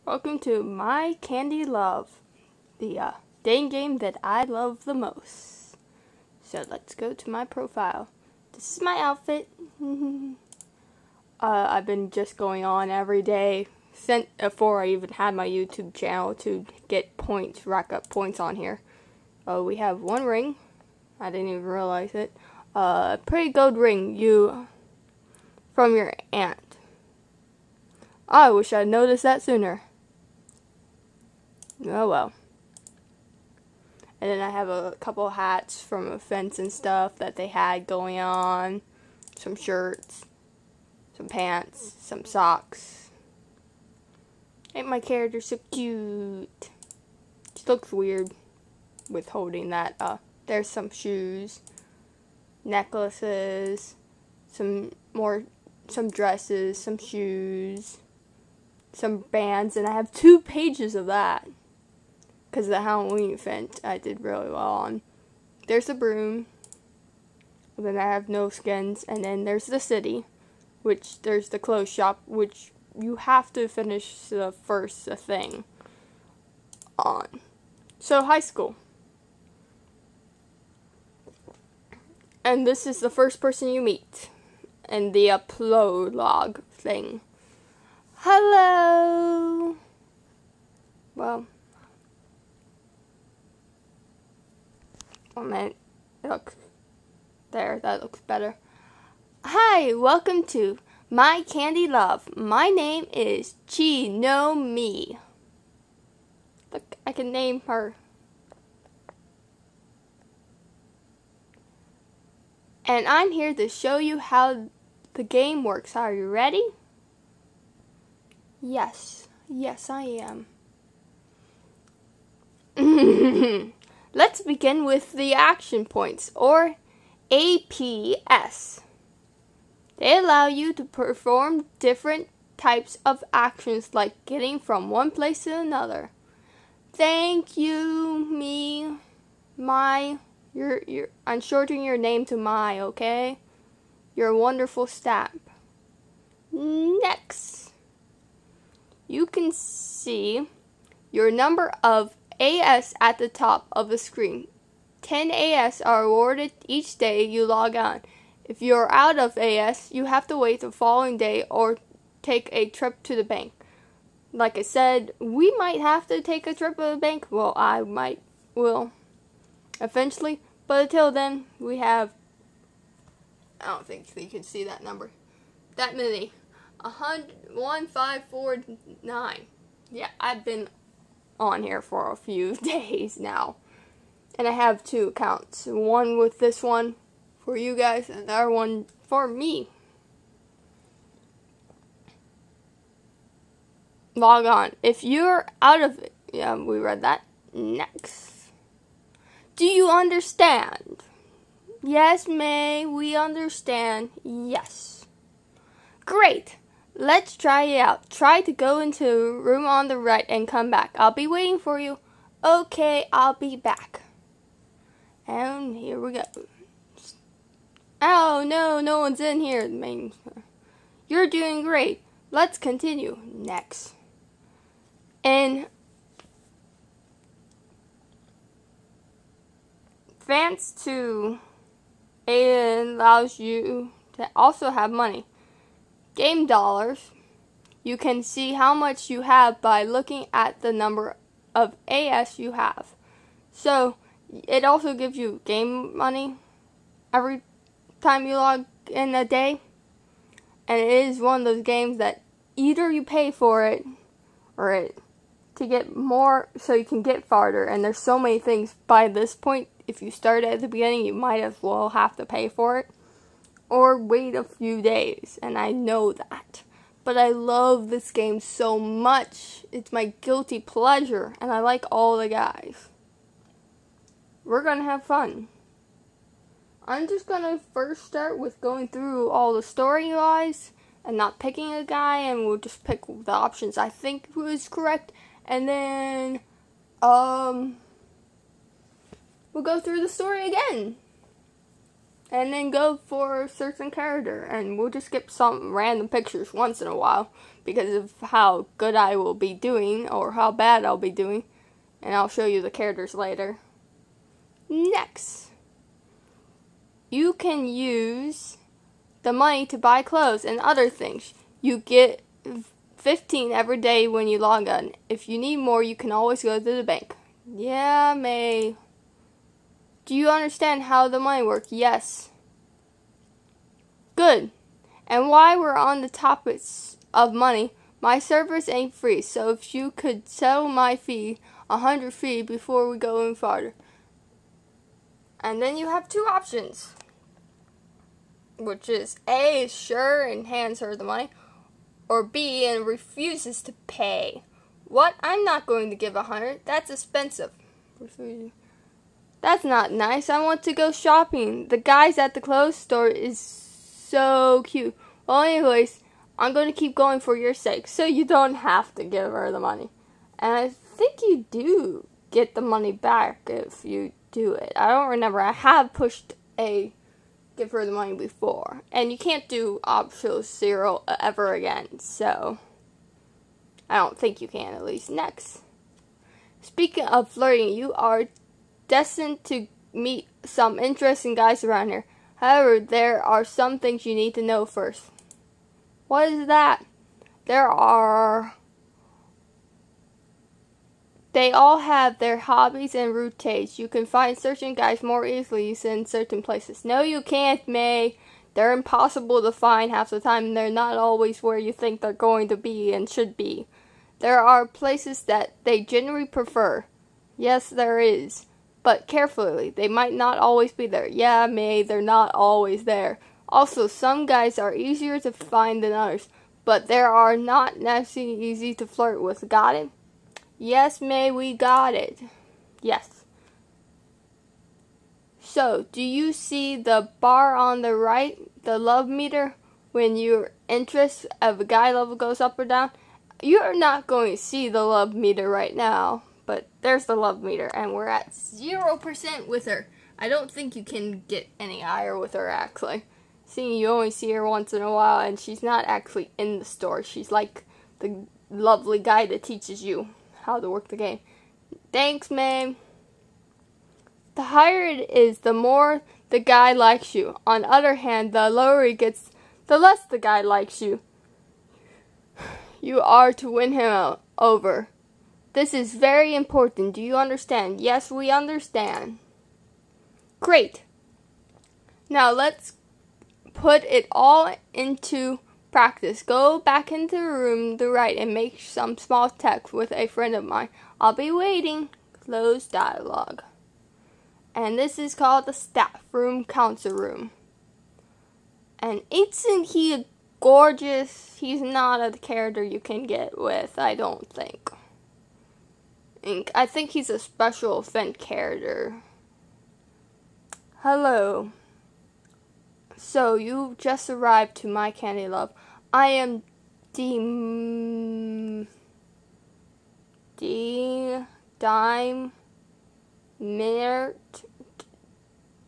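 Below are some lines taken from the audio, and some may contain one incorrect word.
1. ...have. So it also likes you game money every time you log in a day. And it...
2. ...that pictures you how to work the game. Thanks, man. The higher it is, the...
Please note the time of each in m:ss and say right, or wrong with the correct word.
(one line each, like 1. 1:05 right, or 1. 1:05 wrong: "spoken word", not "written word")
1. 4:02 wrong: "gives", not "likes"
2. 7:29 wrong: "teaches", not "pictures".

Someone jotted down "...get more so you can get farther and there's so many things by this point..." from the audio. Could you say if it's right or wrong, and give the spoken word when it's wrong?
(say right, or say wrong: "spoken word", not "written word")
right.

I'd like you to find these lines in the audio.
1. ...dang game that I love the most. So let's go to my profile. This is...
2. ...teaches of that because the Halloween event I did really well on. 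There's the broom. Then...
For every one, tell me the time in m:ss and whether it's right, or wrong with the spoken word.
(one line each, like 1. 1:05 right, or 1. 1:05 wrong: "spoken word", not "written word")
1. 0:03 right
2. 1:00 wrong: "pages", not "teaches".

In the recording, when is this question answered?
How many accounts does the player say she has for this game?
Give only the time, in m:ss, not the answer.
3:04.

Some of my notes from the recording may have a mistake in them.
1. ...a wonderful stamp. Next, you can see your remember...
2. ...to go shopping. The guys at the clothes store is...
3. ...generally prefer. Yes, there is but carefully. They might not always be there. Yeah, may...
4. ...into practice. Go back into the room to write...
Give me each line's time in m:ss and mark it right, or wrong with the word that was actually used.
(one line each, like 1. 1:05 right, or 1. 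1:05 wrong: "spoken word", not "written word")
1. 2:24 wrong: "number", not "remember"
2. 5:50 right
3. 6:45 right
4. 7:54 right.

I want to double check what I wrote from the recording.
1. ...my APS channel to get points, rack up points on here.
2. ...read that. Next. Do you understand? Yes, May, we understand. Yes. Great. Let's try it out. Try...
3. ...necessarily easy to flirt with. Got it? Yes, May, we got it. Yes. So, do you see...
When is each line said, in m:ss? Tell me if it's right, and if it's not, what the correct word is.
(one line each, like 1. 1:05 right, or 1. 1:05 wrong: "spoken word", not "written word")
1. 0:15 wrong: "YouTube", not "APS"
2. 3:16 right
3. 6:57 right.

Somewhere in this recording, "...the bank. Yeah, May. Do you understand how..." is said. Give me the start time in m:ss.
5:16.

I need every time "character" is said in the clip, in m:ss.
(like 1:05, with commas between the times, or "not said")
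0:44, 4:53, 5:02, 8:12, 8:18.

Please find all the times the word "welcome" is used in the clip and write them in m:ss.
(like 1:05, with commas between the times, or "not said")
0:00, 1:39.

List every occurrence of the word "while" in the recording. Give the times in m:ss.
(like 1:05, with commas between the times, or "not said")
4:56, 5:25, 7:24.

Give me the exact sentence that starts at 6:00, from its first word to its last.
And I think you do get the money back if you do it.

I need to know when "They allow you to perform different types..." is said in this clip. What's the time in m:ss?
2:09.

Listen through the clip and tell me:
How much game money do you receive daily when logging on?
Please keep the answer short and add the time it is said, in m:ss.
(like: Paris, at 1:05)
15, at 5:12.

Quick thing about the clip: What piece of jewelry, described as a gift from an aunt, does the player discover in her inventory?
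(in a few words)
gold ring.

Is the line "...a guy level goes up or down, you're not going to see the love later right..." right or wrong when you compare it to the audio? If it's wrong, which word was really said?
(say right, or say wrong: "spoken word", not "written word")
wrong: "meter", not "later".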